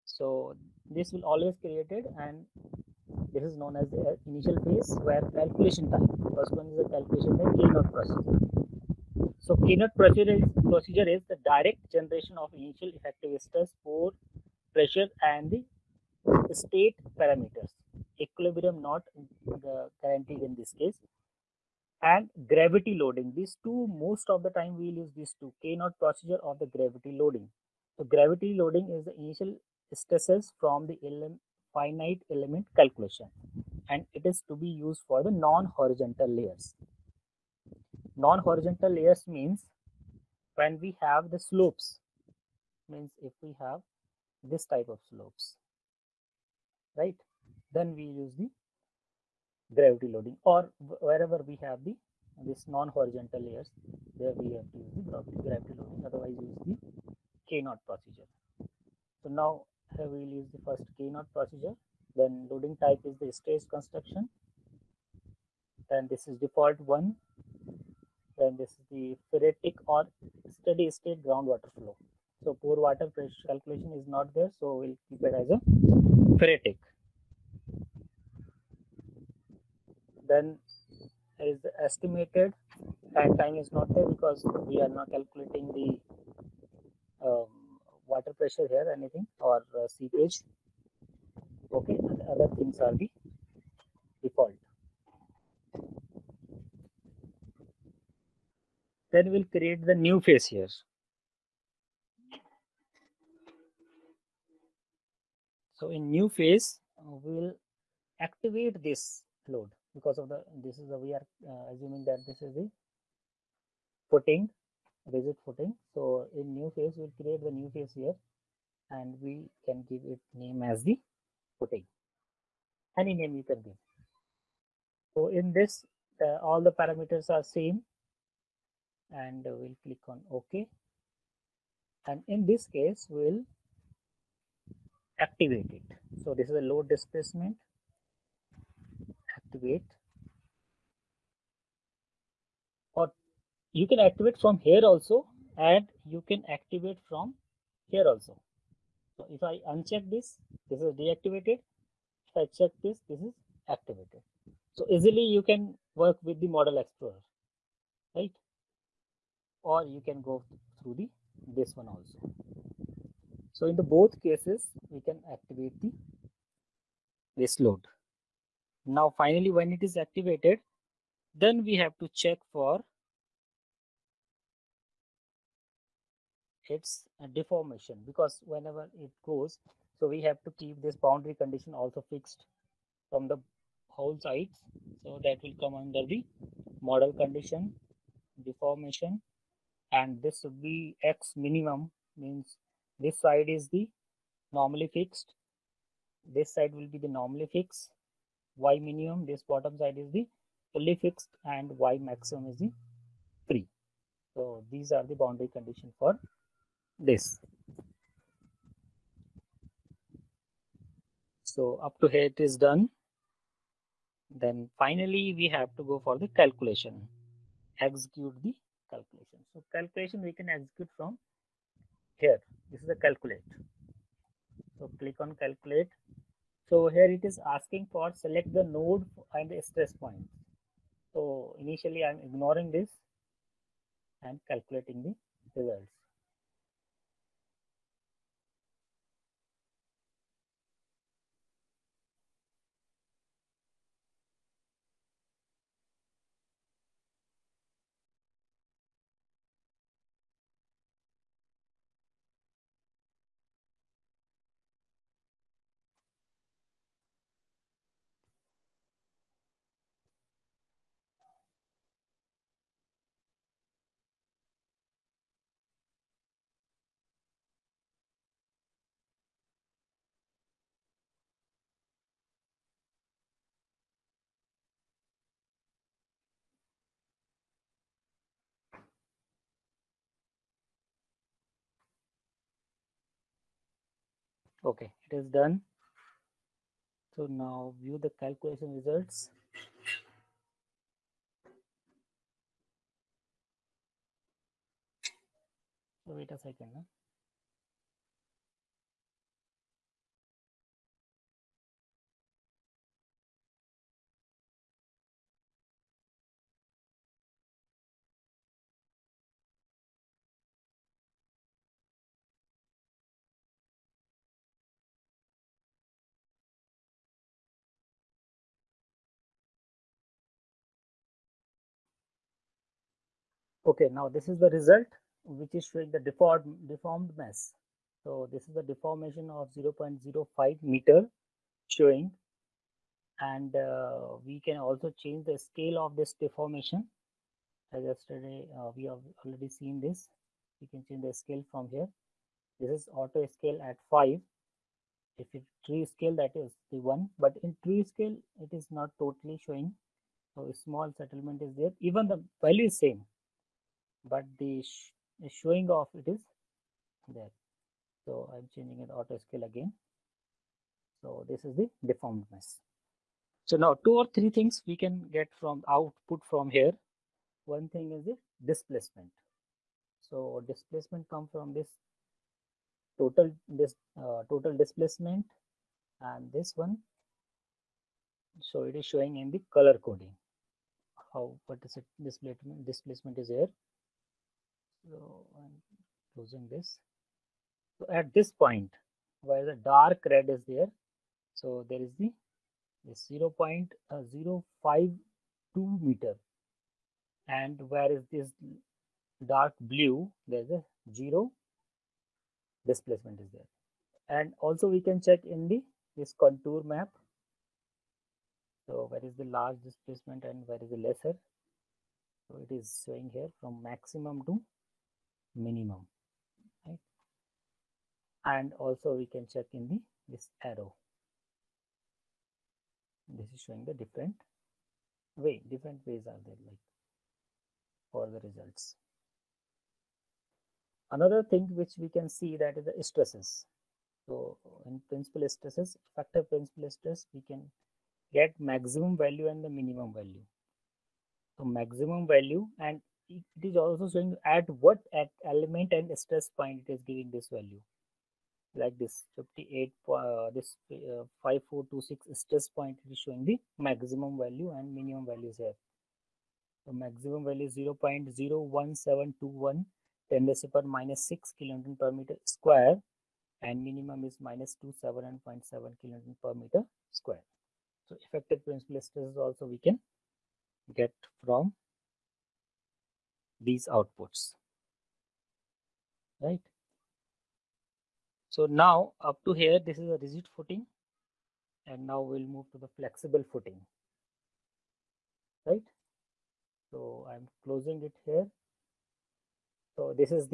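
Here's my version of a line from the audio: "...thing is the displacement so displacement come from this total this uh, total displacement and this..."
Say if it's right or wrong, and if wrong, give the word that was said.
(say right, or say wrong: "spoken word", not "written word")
right.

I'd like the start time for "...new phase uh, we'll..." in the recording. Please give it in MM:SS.
01:46.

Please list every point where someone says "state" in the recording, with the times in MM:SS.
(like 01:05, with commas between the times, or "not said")
00:16, 01:10.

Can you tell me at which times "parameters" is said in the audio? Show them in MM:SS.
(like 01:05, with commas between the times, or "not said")
00:17, 02:06.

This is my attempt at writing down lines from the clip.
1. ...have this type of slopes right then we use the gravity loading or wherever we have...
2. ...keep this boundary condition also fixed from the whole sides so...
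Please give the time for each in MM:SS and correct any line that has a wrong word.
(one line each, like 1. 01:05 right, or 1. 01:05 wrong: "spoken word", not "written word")
1. 00:43 right
2. 03:00 right.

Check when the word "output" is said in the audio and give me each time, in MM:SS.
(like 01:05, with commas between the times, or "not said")
06:05, 07:53.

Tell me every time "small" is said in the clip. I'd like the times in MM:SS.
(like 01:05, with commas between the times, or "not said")
05:50.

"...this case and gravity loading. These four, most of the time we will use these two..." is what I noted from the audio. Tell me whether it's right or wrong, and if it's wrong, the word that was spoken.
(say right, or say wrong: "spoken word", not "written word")
wrong: "two", not "four".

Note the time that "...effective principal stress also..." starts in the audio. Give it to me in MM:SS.
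07:48.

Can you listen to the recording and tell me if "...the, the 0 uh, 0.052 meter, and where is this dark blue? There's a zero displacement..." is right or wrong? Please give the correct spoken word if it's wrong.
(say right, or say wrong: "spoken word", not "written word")
right.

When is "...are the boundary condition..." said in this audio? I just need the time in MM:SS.
03:24.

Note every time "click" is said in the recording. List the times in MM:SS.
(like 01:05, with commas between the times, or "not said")
02:09, 03:44.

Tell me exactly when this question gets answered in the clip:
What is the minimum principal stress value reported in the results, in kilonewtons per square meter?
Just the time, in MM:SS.
07:44.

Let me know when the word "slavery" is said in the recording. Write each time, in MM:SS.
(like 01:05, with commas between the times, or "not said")
not said.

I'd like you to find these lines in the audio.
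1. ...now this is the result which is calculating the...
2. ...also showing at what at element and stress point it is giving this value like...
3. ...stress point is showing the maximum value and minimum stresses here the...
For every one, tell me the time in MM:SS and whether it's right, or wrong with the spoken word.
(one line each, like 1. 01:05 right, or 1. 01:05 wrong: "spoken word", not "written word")
1. 05:23 wrong: "showing", not "calculating"
2. 07:23 right
3. 07:32 wrong: "values", not "stresses".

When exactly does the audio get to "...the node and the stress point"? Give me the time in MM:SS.
03:48.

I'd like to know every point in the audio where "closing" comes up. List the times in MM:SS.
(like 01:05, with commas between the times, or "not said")
06:26, 08:07.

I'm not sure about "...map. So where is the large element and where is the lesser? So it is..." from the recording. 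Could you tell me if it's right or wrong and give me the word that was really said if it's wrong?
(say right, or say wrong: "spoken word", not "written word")
wrong: "displacement", not "element".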